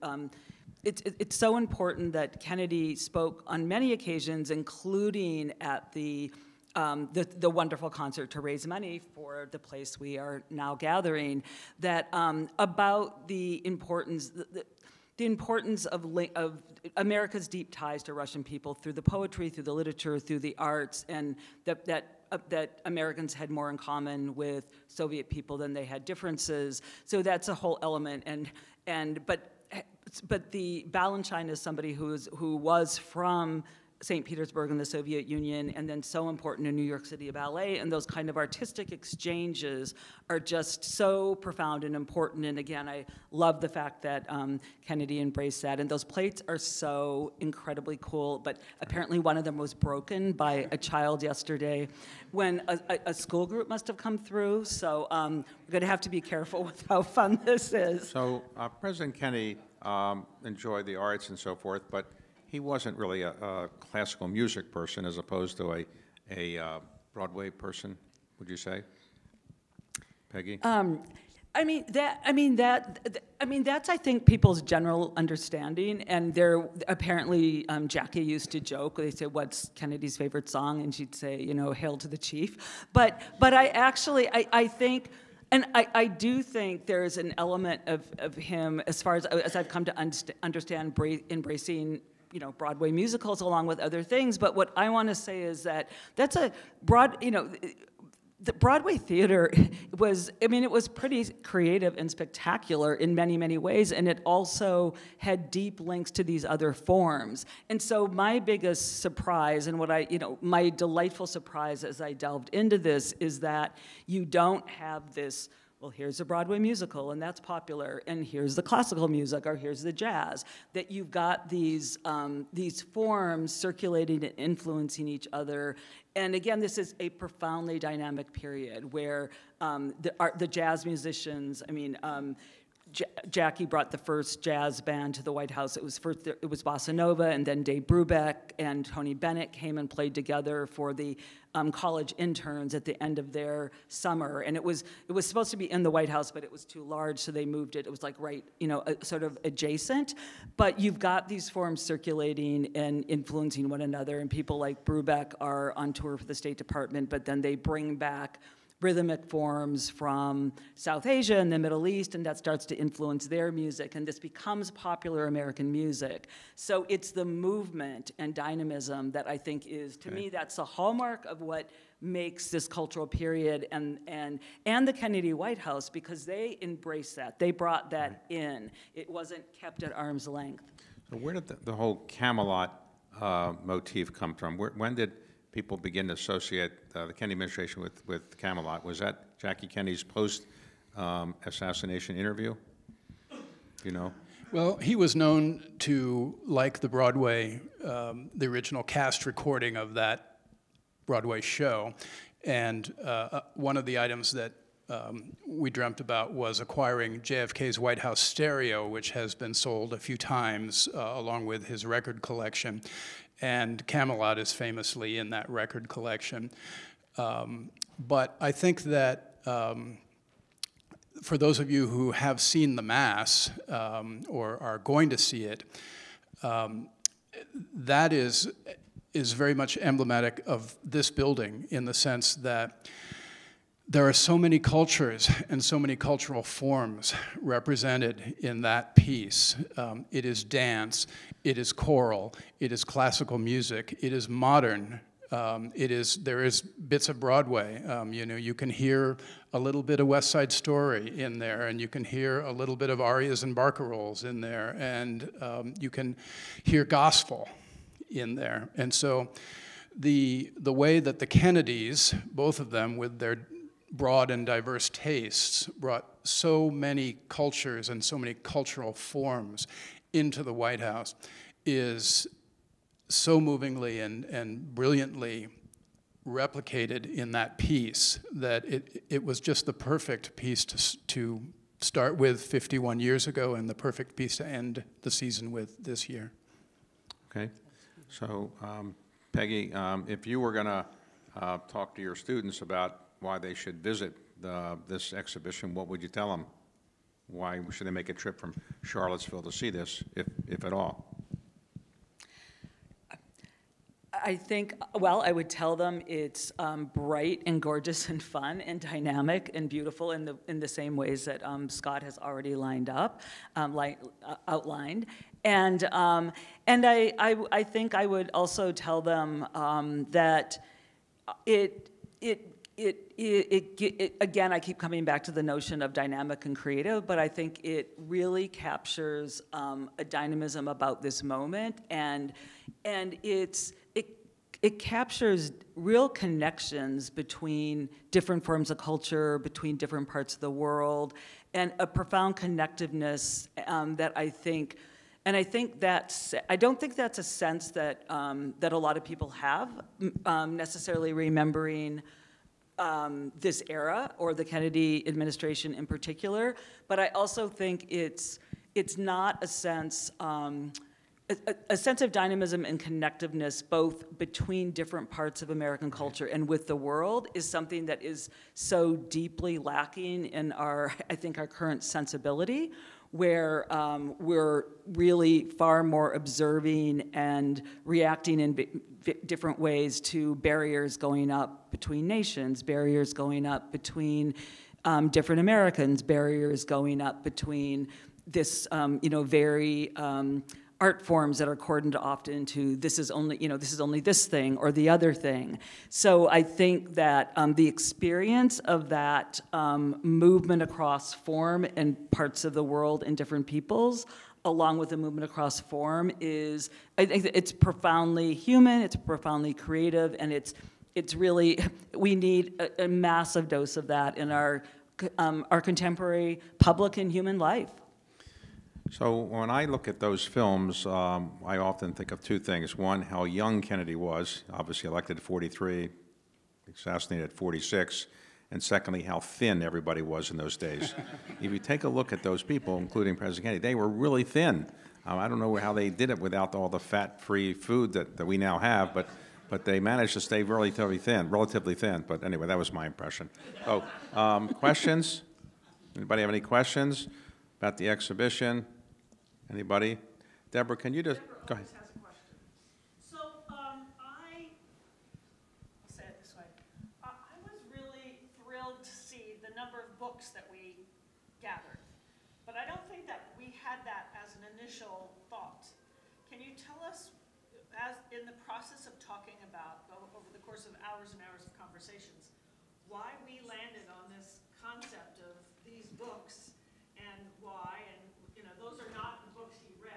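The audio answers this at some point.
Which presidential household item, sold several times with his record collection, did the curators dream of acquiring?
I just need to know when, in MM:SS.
03:27.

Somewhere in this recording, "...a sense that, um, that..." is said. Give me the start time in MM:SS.
05:47.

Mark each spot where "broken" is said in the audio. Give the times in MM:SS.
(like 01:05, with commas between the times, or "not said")
00:49.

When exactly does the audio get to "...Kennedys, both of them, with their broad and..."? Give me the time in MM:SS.
04:21.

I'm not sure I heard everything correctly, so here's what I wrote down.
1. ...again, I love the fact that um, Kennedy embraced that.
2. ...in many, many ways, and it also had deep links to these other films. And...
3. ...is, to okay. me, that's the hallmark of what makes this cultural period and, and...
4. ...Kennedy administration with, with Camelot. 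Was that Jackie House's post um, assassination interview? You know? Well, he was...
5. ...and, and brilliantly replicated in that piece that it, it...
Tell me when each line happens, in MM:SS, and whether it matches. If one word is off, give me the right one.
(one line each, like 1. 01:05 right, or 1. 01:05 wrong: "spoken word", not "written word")
1. 00:42 right
2. 01:42 wrong: "forms", not "films"
3. 02:49 right
4. 03:07 wrong: "Kennedy", not "House"
5. 04:33 right.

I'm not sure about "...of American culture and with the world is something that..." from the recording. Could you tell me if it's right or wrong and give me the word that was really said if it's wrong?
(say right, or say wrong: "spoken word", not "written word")
right.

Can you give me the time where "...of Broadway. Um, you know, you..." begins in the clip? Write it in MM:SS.
04:07.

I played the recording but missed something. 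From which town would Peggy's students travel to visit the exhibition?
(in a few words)
Charlottesville.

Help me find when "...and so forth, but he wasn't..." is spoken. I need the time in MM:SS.
01:01.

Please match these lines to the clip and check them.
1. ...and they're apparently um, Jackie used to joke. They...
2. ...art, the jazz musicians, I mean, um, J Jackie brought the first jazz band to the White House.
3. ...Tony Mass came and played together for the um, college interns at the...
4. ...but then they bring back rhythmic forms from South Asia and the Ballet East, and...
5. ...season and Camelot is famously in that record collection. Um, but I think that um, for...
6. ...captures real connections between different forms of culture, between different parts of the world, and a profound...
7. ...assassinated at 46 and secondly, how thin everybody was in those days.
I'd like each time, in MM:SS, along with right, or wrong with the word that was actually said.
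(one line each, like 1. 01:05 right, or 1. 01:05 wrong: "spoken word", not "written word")
1. 01:16 right
2. 02:10 right
3. 02:18 wrong: "Bennett", not "Mass"
4. 02:37 wrong: "Middle", not "Ballet"
5. 03:32 wrong: "collection", not "season"
6. 05:34 right
7. 07:06 right.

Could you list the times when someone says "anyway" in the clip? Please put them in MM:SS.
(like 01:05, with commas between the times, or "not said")
07:22.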